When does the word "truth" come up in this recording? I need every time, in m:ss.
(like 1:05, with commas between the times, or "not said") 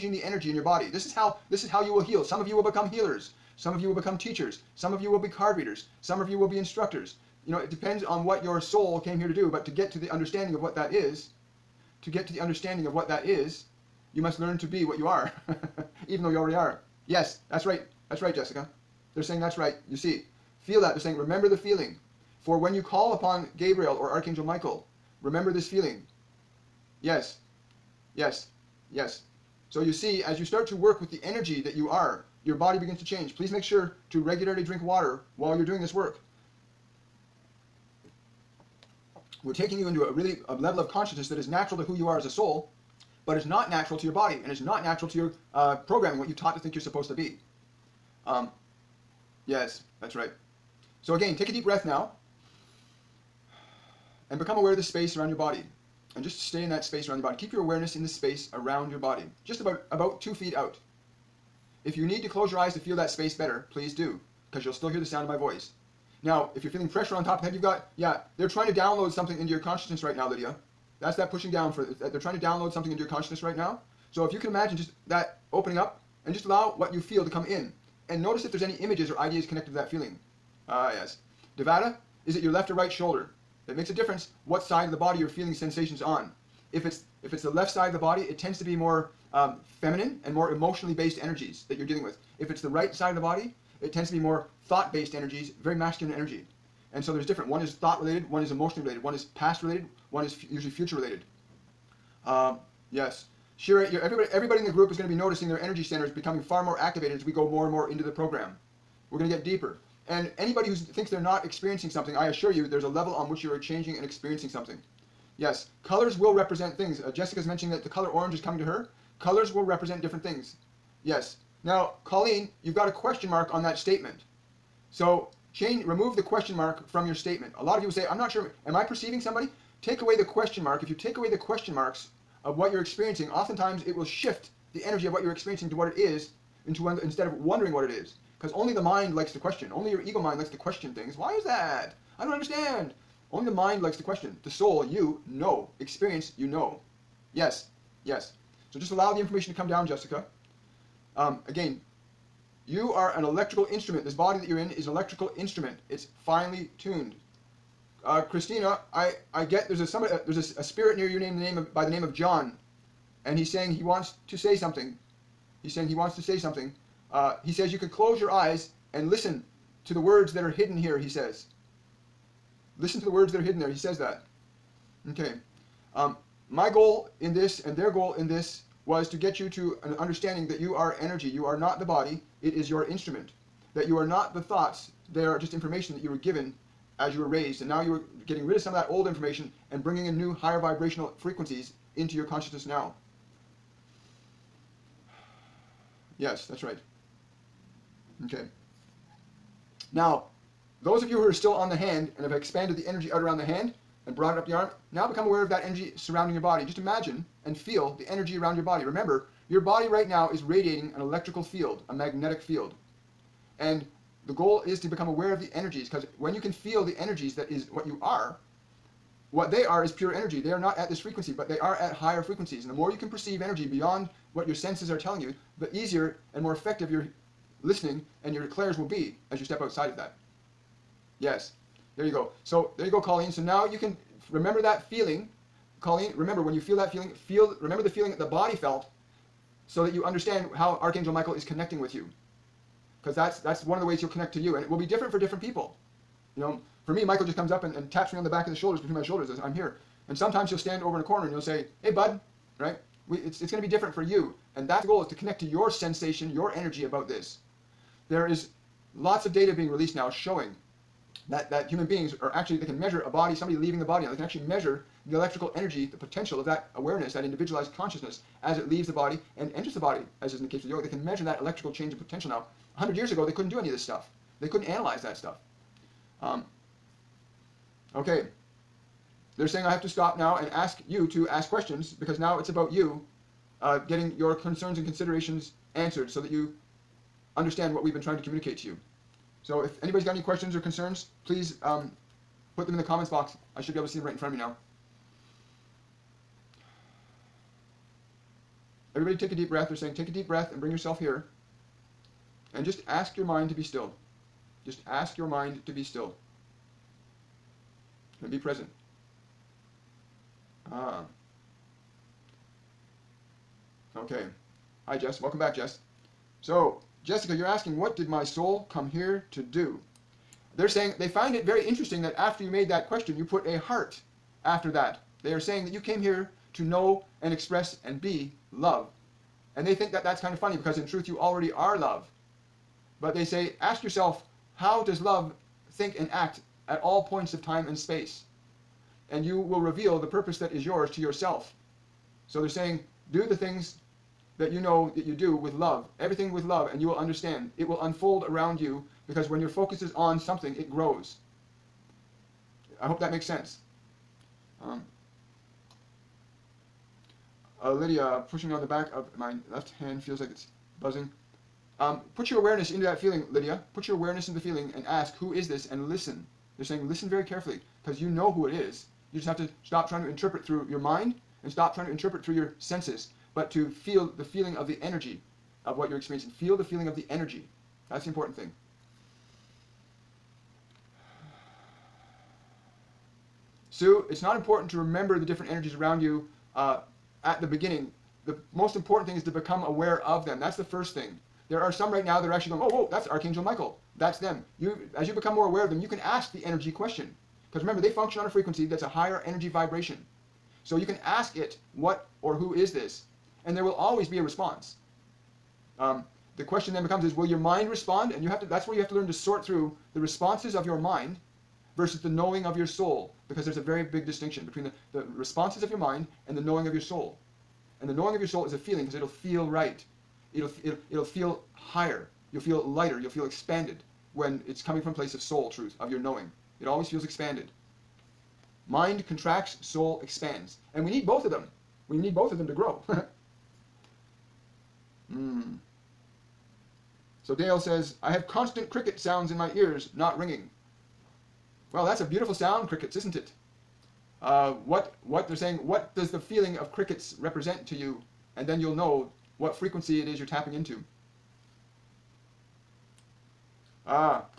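5:30, 7:05.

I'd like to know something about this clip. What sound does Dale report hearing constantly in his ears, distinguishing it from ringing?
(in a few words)
Cricket sounds.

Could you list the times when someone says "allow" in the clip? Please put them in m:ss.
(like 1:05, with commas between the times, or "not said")
1:16, 2:28.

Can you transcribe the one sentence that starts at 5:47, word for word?
It will unfold around you because when your focus is on something, it grows.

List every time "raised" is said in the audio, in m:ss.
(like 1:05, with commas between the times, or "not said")
3:07.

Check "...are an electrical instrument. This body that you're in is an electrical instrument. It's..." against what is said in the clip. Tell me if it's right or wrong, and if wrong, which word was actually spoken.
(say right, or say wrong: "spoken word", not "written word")
right.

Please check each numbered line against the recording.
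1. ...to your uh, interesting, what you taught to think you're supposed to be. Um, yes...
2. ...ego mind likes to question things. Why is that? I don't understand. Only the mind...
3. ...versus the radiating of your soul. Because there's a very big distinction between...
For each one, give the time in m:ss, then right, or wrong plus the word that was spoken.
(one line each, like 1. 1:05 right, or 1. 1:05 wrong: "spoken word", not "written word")
1. 0:45 wrong: "programming", not "interesting"
2. 2:19 right
3. 6:51 wrong: "knowing", not "radiating".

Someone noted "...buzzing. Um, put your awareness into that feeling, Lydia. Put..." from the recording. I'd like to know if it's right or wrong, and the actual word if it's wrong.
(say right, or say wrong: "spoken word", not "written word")
right.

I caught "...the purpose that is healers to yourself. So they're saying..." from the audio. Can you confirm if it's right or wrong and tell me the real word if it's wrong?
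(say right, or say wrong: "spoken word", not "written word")
wrong: "yours", not "healers".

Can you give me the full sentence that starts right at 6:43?
And there will always be a response.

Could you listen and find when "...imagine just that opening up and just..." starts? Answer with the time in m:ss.
1:14.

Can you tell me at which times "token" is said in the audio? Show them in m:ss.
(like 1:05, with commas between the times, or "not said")
not said.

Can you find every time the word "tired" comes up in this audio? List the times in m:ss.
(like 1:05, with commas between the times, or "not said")
not said.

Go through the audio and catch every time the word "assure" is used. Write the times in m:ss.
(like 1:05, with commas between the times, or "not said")
1:52.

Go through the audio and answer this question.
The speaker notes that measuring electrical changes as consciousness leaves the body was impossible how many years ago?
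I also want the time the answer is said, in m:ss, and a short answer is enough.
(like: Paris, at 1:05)
100, at 4:32.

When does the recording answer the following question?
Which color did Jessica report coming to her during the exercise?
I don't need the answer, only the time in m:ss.
1:58.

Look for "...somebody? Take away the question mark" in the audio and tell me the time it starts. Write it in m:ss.
2:09.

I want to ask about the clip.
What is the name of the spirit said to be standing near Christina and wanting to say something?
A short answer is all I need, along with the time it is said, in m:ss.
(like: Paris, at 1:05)
John, at 2:42.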